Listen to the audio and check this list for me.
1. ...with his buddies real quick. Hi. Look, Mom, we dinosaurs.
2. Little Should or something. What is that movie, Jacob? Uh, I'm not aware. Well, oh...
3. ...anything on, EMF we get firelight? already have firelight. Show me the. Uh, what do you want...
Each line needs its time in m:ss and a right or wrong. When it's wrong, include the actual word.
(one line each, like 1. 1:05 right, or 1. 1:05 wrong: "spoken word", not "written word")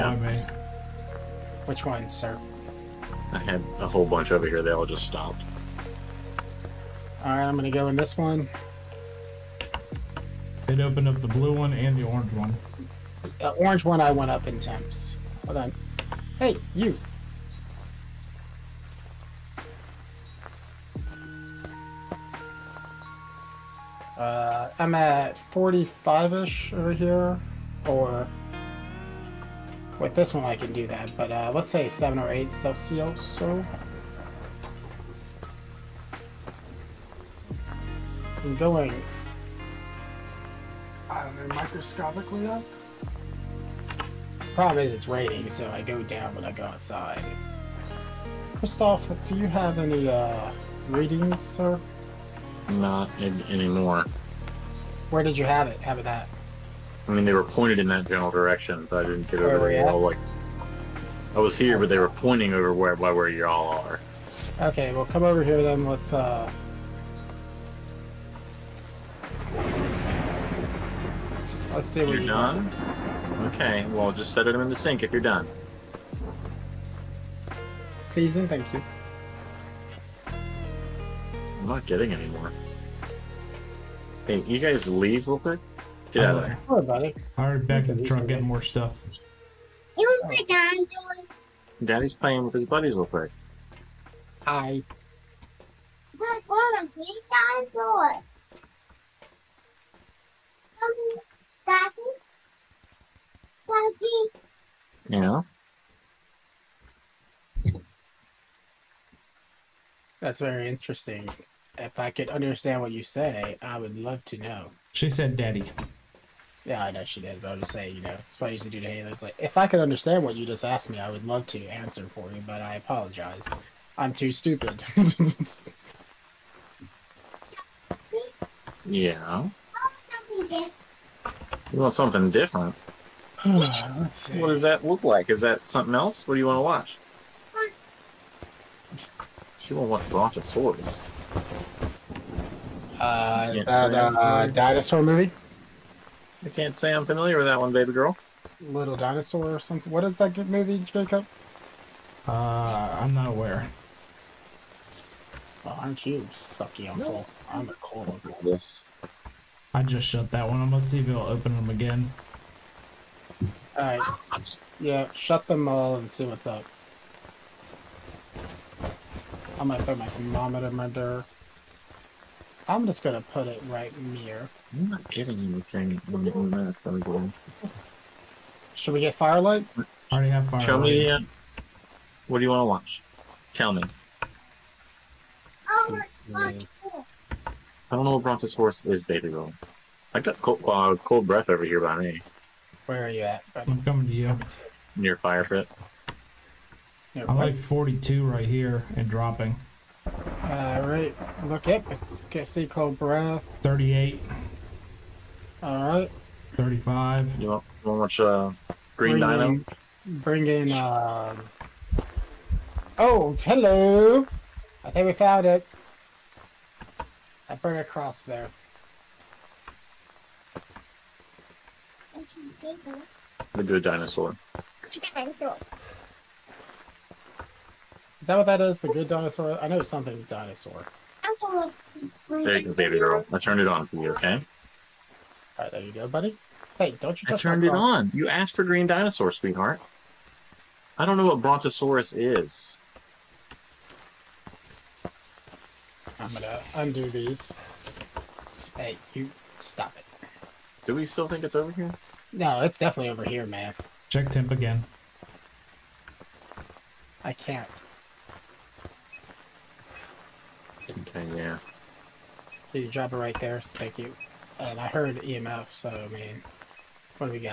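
1. 1:32 right
2. 2:28 wrong: "Dinosaur", not "Should"
3. 2:55 wrong: "Should", not "EMF".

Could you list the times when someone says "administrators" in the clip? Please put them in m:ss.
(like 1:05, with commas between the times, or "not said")
not said.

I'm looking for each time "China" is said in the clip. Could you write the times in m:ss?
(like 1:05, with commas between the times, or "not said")
not said.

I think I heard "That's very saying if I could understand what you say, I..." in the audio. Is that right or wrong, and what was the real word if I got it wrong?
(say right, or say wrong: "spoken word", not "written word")
wrong: "interesting", not "saying".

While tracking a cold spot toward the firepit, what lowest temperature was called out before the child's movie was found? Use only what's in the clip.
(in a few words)
35.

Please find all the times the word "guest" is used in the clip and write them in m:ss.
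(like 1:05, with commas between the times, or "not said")
not said.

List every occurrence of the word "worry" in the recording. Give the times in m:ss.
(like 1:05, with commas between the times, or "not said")
1:26.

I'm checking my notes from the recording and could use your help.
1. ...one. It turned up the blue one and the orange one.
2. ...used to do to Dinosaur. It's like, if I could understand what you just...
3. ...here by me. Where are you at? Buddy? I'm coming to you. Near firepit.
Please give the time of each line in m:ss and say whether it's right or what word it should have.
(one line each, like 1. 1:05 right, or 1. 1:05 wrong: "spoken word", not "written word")
1. 0:08 wrong: "opened", not "turned"
2. 1:58 wrong: "Halo", not "Dinosaur"
3. 3:11 right.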